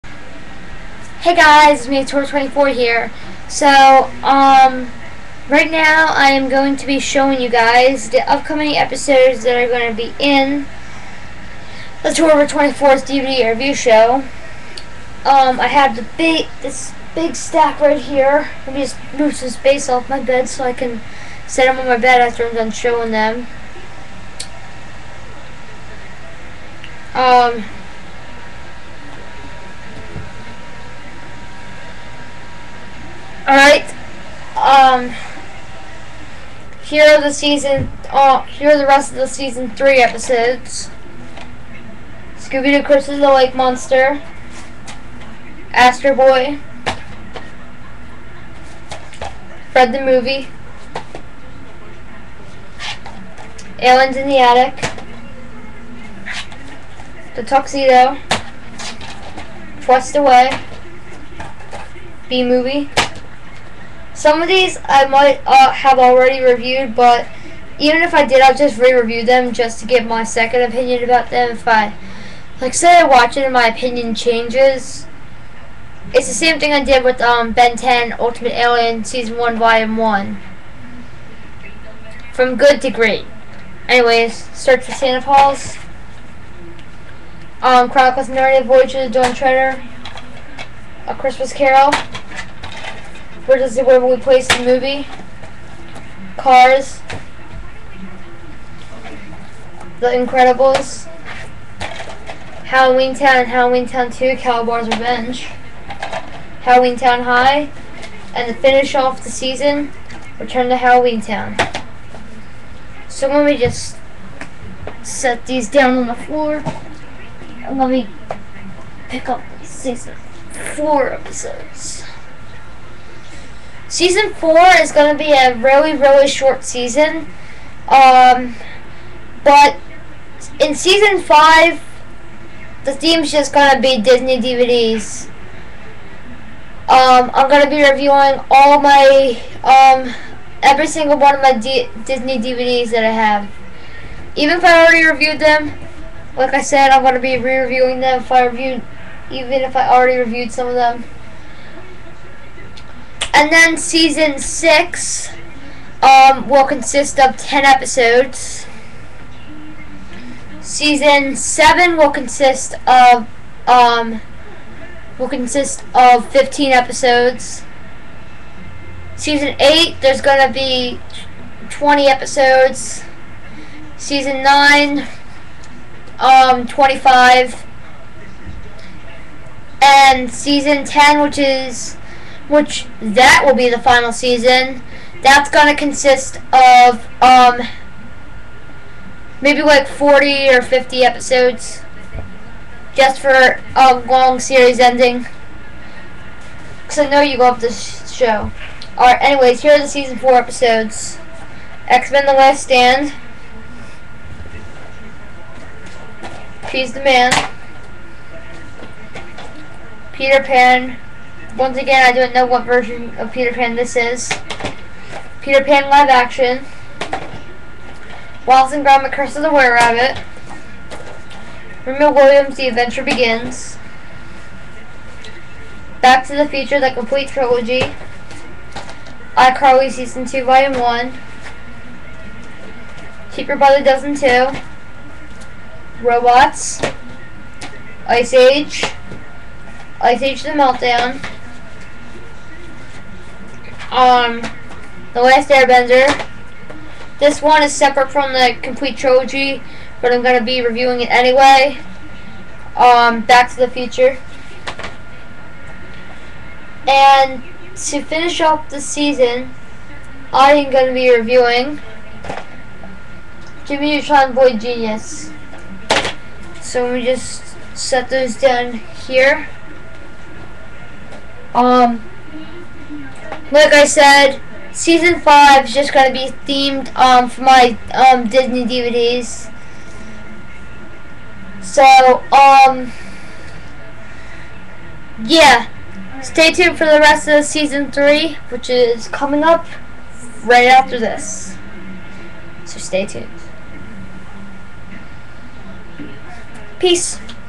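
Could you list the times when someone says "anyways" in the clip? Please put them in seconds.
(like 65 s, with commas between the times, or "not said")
83 s, 199 s, 251 s.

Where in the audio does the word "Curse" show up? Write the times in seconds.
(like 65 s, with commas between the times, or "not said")
42 s, 219 s.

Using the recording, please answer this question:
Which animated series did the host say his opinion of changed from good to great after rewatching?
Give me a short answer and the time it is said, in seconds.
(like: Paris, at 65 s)
Ben 10 Ultimate Alien, at 77 s.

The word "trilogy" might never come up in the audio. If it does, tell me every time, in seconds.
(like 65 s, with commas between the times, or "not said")
227 s, 248 s.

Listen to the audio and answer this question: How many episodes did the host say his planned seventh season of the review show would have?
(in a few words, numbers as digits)
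15.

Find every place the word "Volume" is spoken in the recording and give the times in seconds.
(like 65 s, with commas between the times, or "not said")
79 s, 230 s.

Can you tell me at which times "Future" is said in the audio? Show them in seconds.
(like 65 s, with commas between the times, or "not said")
226 s, 253 s.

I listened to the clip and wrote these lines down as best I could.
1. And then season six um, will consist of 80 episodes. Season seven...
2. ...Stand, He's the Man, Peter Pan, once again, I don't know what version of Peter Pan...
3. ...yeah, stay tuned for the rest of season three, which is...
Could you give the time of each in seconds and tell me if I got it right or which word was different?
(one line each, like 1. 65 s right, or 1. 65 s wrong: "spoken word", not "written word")
1. 153 s wrong: "10", not "80"
2. 202 s right
3. 285 s right.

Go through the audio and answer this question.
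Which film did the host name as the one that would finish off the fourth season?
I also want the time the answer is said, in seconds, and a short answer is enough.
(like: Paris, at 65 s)
Jimmy Neutron Boy Genius, at 263 s.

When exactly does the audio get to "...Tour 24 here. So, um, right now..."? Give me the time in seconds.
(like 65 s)
2 s.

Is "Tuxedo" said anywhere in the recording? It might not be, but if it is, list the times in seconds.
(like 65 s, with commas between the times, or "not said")
57 s.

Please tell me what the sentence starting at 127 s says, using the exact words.
Um, but in season five, the theme's just going to be Disney DVDs.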